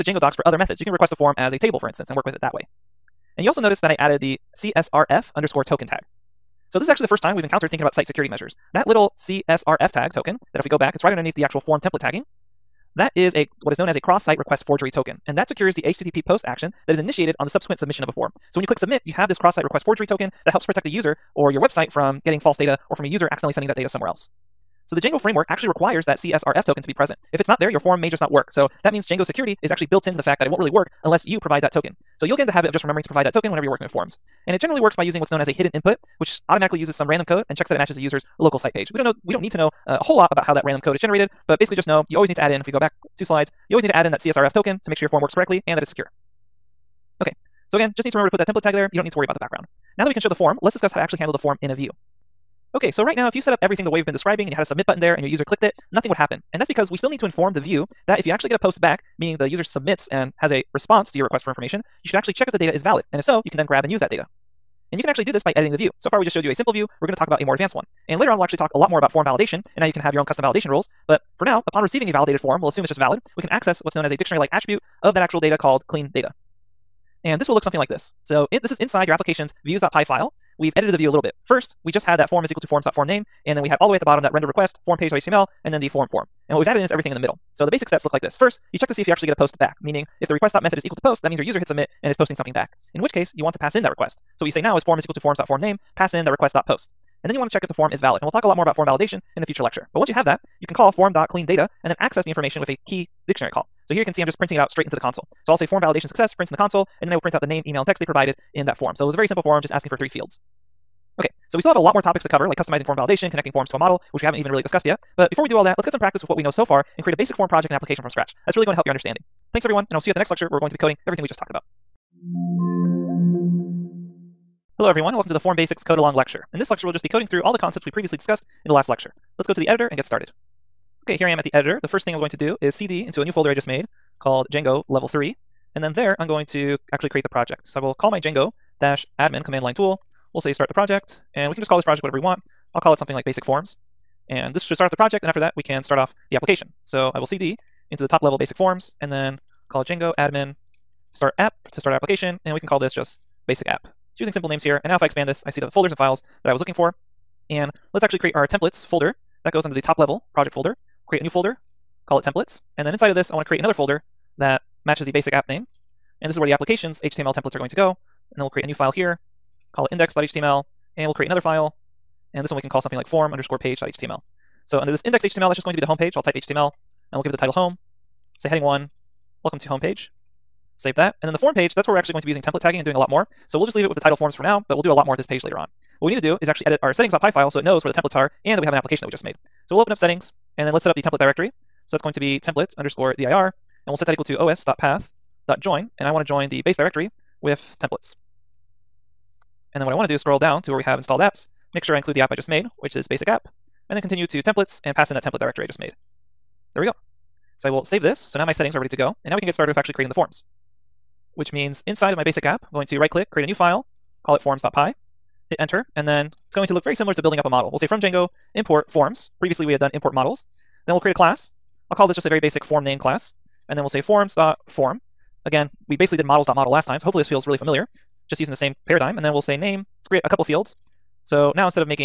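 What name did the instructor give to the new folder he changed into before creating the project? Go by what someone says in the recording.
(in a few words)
Django level 3.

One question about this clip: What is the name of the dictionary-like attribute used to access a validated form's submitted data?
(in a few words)
cleaned data.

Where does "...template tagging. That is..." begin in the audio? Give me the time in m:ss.
0:11.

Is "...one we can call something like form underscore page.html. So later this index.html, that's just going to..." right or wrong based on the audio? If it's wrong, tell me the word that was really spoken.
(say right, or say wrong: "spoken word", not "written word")
wrong: "under", not "later".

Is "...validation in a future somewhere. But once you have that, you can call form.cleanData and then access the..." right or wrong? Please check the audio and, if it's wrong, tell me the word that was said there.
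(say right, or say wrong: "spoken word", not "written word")
wrong: "lecture", not "somewhere".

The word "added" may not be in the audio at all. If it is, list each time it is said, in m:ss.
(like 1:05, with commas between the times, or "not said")
0:03, 1:26.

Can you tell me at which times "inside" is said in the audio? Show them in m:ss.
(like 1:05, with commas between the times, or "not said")
1:18, 2:42, 3:31.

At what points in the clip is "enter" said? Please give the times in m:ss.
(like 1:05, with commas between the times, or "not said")
3:35.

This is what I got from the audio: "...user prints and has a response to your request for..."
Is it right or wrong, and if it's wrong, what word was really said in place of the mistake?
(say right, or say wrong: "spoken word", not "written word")
wrong: "submits", not "prints".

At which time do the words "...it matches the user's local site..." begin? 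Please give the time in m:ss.
0:37.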